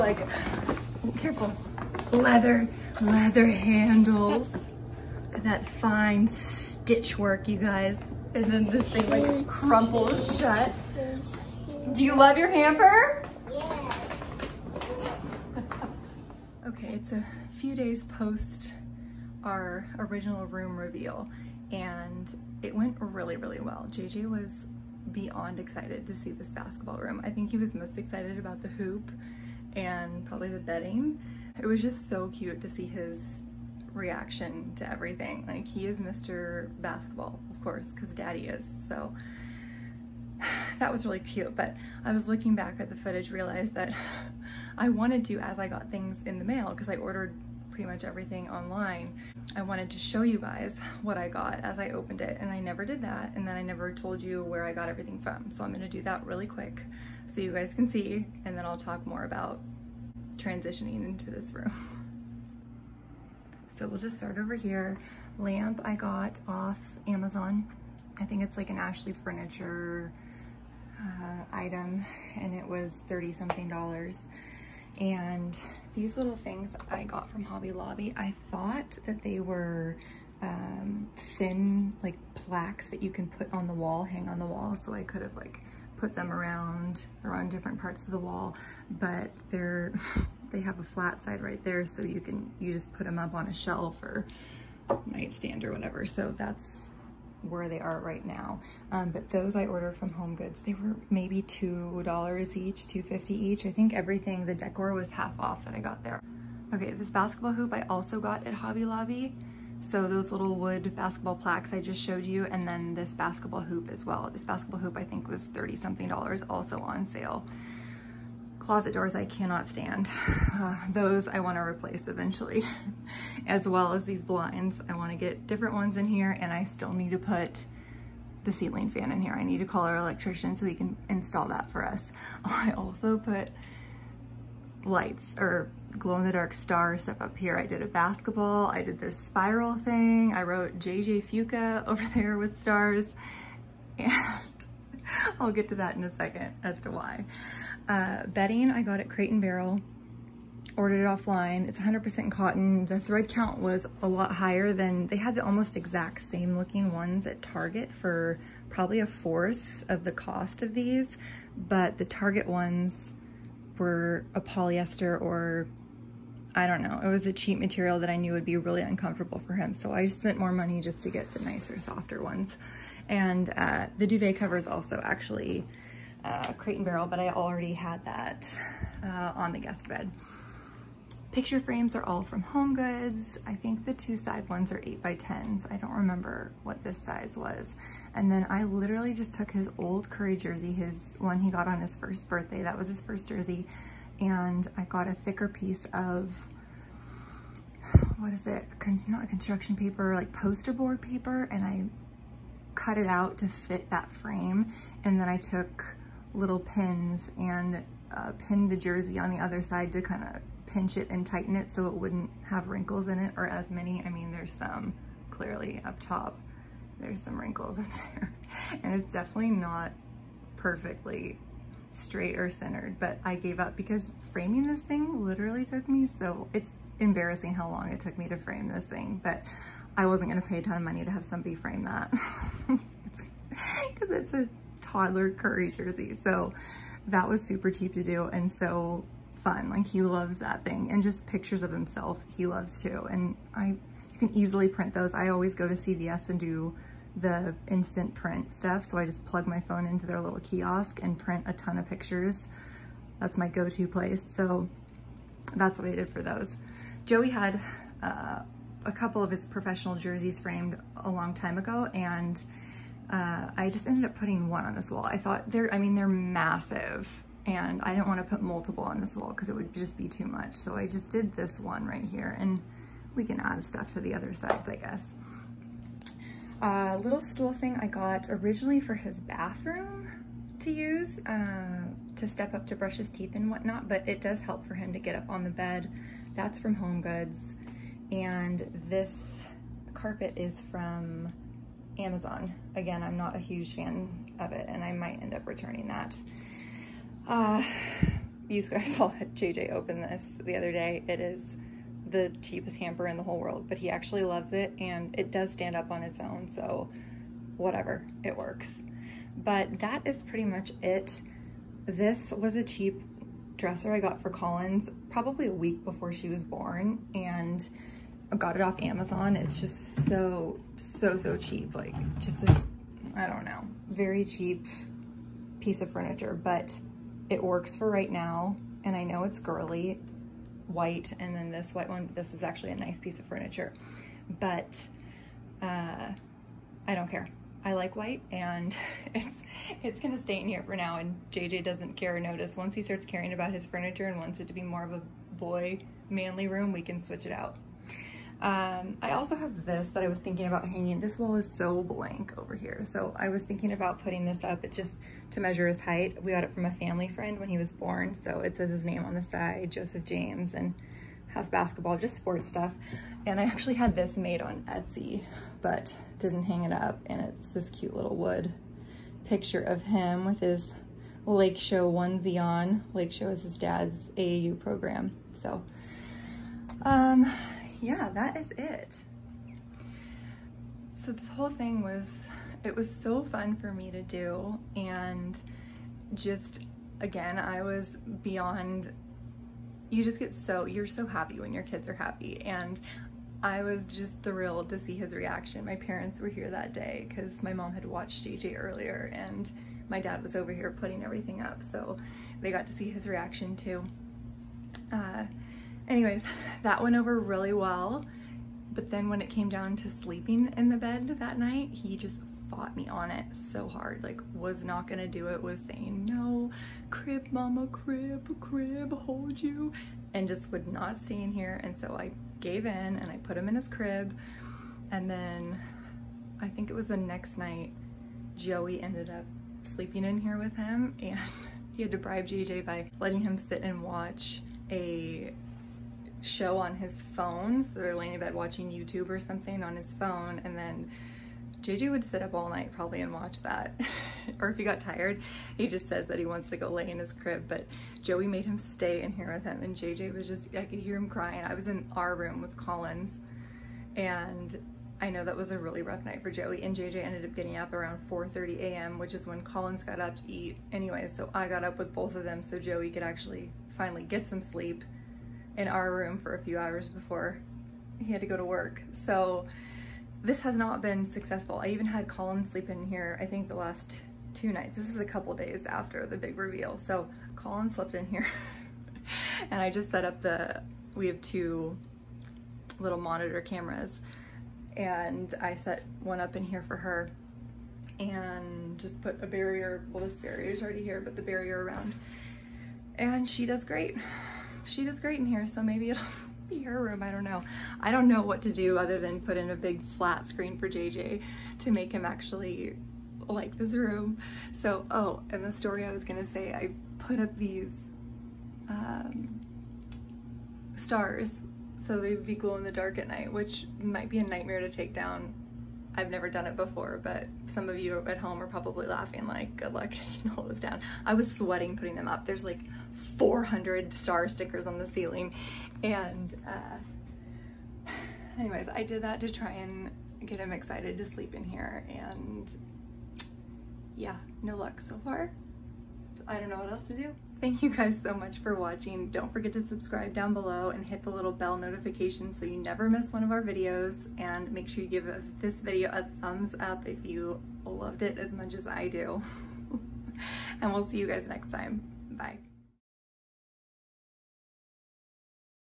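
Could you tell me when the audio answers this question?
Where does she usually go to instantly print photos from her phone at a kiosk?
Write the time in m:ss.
4:05.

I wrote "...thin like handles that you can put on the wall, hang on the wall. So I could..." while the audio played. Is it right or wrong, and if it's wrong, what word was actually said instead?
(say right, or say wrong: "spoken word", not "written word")
wrong: "plaques", not "handles".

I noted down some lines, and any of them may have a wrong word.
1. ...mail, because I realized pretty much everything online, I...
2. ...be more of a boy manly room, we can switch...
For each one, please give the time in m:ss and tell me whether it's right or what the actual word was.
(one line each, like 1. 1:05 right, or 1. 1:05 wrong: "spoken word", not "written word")
1. 0:46 wrong: "ordered", not "realized"
2. 5:44 right.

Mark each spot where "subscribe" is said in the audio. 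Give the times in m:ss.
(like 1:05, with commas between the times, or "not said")
8:59.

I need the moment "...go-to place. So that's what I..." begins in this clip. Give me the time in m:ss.
4:13.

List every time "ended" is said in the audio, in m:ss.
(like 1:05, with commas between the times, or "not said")
4:23, 7:08, 7:37.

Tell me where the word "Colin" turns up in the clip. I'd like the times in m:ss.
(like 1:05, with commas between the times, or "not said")
7:52, 7:57.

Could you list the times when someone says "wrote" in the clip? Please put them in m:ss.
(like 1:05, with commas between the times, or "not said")
2:20.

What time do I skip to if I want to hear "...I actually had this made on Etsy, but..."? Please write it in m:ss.
6:03.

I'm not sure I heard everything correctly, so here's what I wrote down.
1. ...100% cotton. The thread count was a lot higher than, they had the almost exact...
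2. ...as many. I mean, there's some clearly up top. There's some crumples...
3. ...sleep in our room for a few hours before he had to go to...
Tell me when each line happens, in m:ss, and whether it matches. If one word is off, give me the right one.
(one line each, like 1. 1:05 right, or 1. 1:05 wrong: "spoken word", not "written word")
1. 2:31 right
2. 3:33 wrong: "wrinkles", not "crumples"
3. 7:44 right.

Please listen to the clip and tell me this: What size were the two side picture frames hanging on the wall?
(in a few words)
8 by 10.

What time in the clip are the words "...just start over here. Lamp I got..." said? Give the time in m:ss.
1:03.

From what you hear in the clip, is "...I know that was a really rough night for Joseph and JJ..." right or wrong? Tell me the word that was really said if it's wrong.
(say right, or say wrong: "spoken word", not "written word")
wrong: "Joey", not "Joseph".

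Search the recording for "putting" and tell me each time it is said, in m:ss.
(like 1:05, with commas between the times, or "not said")
4:24, 5:54, 6:40, 8:41.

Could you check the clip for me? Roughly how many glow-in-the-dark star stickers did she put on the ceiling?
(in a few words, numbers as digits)
400.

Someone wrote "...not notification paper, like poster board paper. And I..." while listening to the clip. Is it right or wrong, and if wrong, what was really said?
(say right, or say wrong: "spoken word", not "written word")
wrong: "construction", not "notification".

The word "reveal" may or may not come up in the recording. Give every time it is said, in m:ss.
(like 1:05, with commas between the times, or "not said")
0:20, 7:56.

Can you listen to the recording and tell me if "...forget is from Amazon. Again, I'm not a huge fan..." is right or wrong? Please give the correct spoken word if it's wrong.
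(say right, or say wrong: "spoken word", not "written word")
wrong: "carpet", not "forget".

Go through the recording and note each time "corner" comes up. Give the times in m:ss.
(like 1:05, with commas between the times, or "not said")
not said.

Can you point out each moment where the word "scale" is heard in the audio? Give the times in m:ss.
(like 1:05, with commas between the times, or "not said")
not said.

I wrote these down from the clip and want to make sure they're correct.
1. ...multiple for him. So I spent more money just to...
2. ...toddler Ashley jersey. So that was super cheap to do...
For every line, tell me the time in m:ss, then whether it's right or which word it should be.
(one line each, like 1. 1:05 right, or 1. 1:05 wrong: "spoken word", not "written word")
1. 2:48 wrong: "uncomfortable", not "multiple"
2. 3:54 wrong: "Curry", not "Ashley".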